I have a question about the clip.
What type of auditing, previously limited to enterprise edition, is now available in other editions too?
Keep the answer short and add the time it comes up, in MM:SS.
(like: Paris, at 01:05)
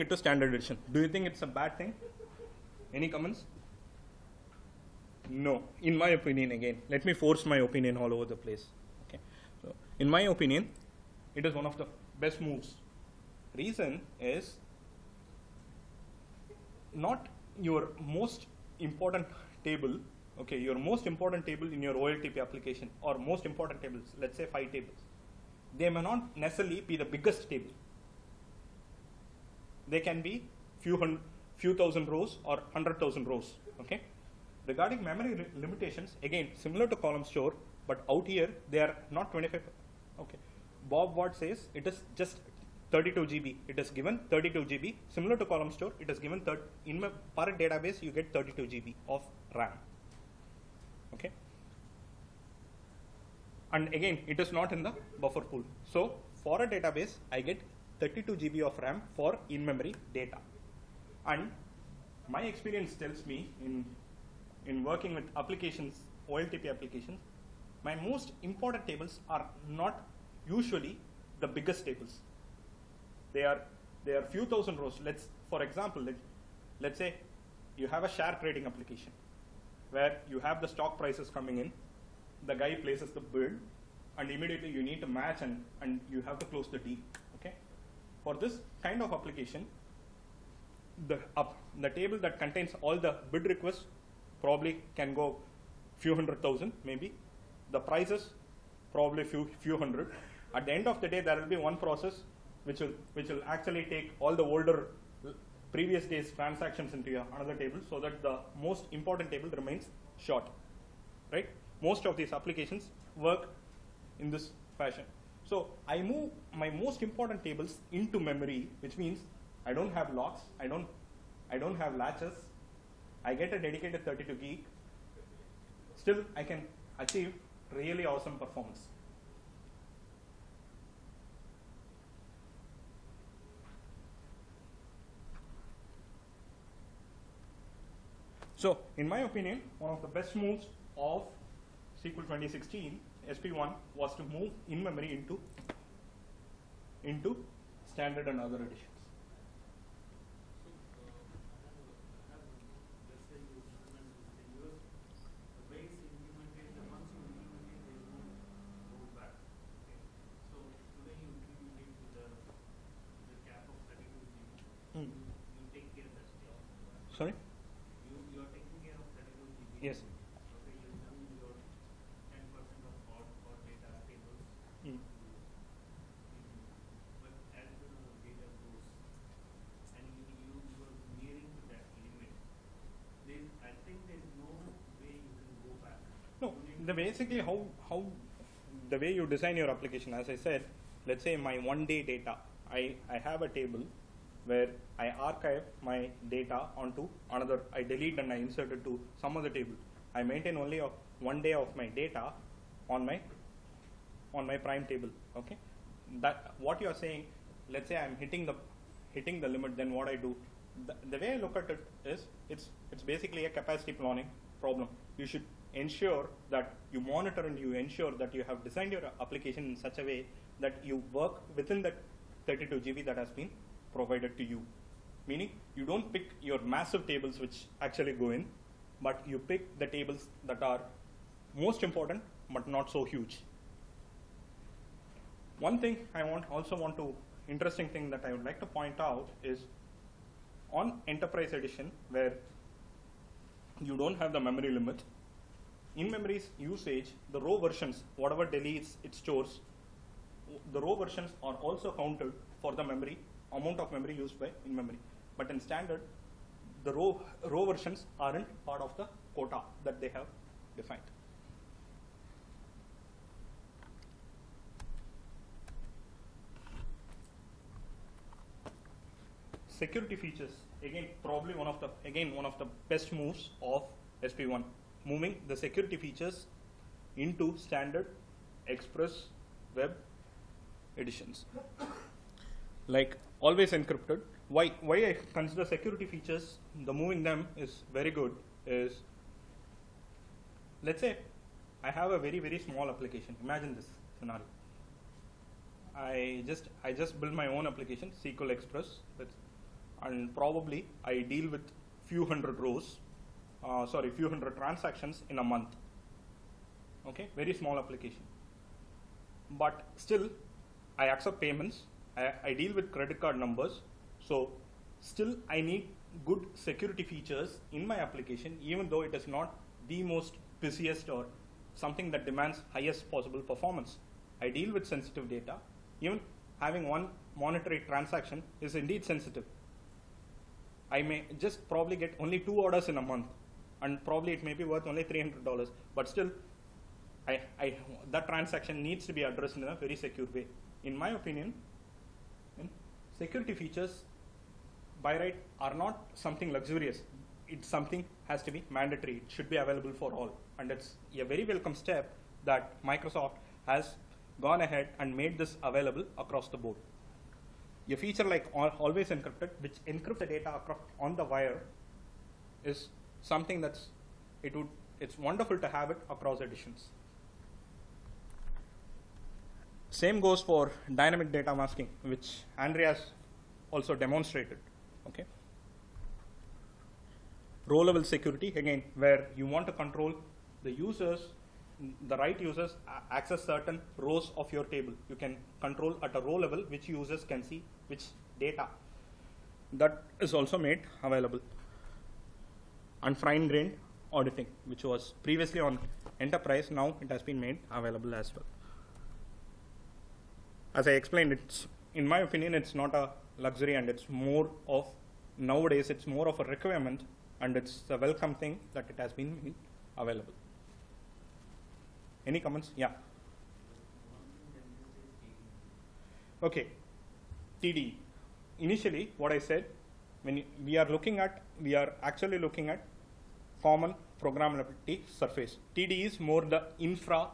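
fine grained auditing, at 06:33.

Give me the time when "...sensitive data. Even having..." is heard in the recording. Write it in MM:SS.
05:24.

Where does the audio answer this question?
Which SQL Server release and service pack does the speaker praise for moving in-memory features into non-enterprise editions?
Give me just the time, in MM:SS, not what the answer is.
02:22.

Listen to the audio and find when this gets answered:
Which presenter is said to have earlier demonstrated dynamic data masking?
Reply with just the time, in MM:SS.
06:12.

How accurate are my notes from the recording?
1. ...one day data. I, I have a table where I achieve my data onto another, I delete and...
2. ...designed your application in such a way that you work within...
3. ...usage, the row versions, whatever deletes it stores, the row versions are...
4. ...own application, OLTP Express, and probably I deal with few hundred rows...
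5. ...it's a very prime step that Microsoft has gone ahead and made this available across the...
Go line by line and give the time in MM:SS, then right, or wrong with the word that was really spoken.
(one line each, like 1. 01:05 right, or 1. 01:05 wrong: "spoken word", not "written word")
1. 03:11 wrong: "archive", not "achieve"
2. 03:38 right
3. 04:06 right
4. 04:57 wrong: "SQL", not "OLTP"
5. 05:50 wrong: "welcome", not "prime".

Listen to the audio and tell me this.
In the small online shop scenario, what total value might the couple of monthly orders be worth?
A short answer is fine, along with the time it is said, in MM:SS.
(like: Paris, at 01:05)
$300, at 05:35.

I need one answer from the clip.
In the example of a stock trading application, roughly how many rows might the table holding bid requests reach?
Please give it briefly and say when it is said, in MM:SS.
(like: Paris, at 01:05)
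few hundred thousand, at 01:35.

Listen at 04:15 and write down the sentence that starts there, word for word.
But in standard, the row, row versions aren't part of the quota that they have defined.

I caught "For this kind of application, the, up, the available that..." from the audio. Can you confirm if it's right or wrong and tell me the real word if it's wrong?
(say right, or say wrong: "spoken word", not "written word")
wrong: "table", not "available".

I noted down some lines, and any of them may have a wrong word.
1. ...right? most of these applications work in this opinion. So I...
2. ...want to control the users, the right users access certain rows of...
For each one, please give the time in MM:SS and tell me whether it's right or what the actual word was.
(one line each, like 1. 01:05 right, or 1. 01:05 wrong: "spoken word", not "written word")
1. 01:51 wrong: "fashion", not "opinion"
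2. 06:19 right.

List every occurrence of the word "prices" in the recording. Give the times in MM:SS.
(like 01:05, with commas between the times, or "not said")
01:20, 01:37.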